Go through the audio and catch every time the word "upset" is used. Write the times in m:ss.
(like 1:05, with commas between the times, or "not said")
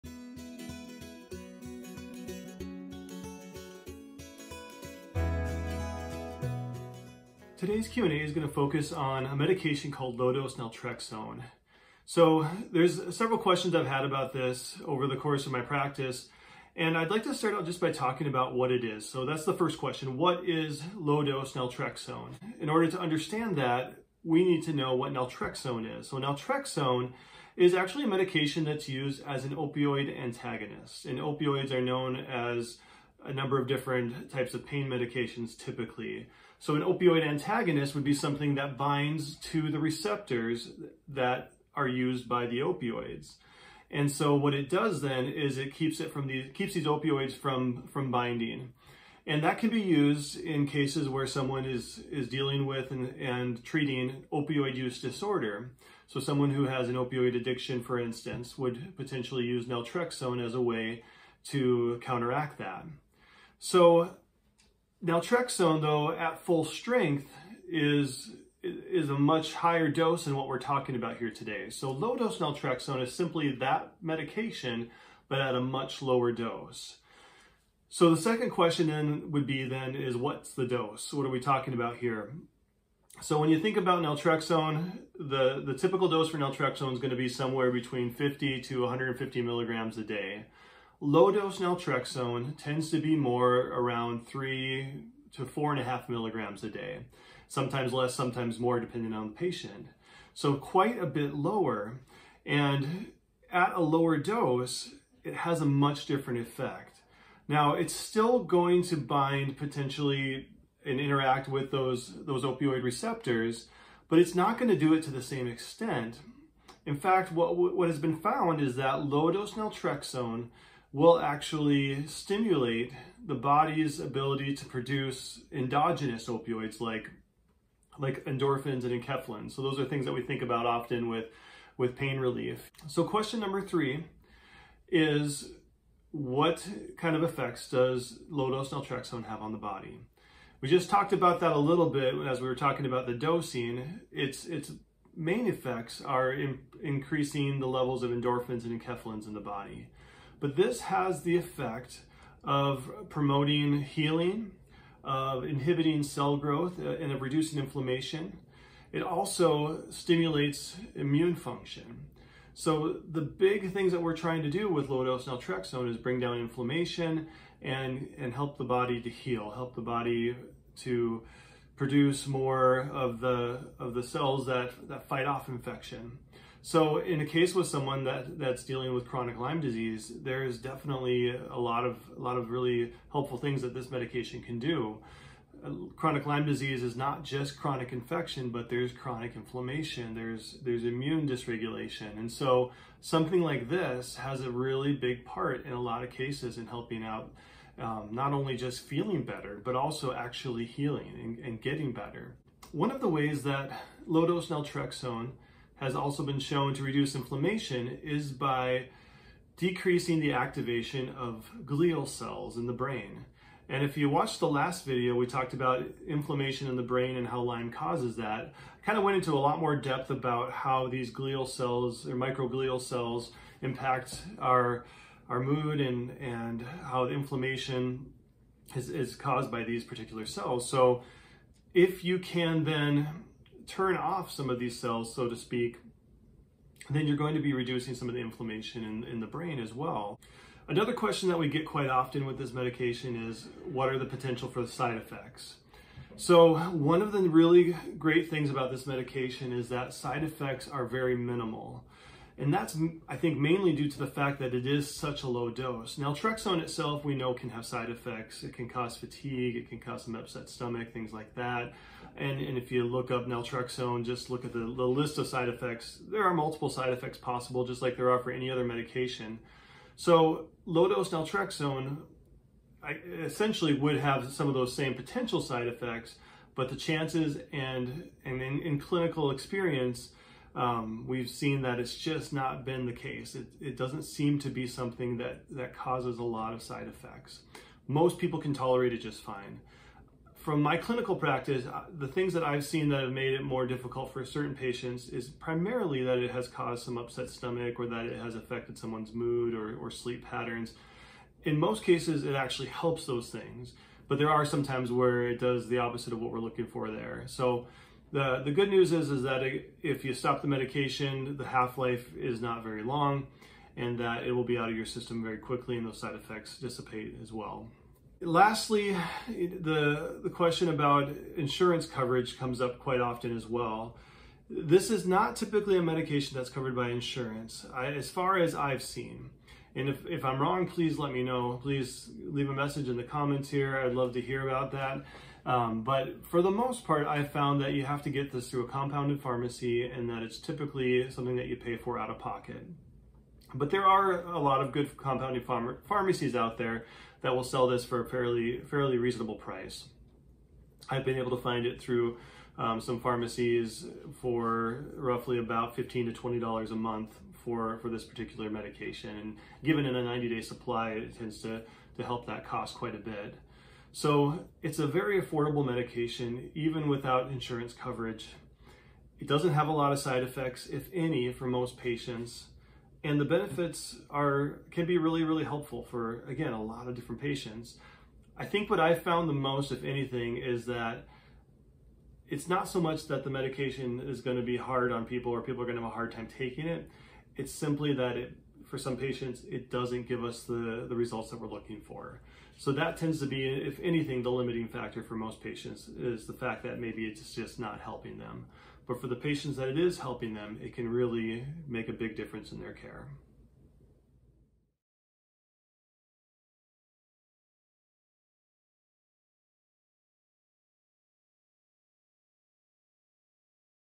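4:20, 4:56.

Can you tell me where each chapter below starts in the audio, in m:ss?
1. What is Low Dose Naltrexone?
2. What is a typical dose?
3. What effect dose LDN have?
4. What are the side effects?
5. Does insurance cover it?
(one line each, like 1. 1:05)
1. 0:20
2. 1:18
3. 2:13
4. 4:01
5. 5:18.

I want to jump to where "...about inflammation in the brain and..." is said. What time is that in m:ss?
3:35.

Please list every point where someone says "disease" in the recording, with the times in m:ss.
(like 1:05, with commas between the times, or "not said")
2:59, 3:06.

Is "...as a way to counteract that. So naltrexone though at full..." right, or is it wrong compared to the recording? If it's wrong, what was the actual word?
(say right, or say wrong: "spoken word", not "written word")
right.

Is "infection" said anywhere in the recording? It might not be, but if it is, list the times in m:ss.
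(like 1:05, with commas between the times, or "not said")
2:55, 3:07.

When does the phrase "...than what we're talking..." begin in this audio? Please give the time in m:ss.
1:10.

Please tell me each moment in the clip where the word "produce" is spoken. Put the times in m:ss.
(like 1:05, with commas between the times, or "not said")
2:04, 2:51.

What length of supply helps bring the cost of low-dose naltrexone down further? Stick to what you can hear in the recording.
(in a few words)
90 day supply.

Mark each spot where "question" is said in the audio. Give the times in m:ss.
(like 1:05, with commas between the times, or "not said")
0:13, 0:19, 1:18, 2:13, 4:00, 5:20.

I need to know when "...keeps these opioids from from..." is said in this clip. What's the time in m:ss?
0:46.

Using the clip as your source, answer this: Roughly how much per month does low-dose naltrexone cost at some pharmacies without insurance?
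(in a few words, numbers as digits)
$15 to $20.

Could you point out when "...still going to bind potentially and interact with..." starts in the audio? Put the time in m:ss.
1:47.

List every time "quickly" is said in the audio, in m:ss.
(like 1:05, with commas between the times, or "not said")
5:15.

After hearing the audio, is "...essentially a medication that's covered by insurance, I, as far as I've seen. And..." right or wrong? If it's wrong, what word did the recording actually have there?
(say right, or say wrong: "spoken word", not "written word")
wrong: "typically", not "essentially".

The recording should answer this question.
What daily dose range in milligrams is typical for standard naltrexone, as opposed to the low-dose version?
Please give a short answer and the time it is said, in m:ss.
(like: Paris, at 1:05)
50 to 150 milligrams, at 1:28.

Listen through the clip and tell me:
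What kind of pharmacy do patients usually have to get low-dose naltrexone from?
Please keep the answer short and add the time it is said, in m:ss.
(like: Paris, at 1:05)
compounded pharmacy, at 5:38.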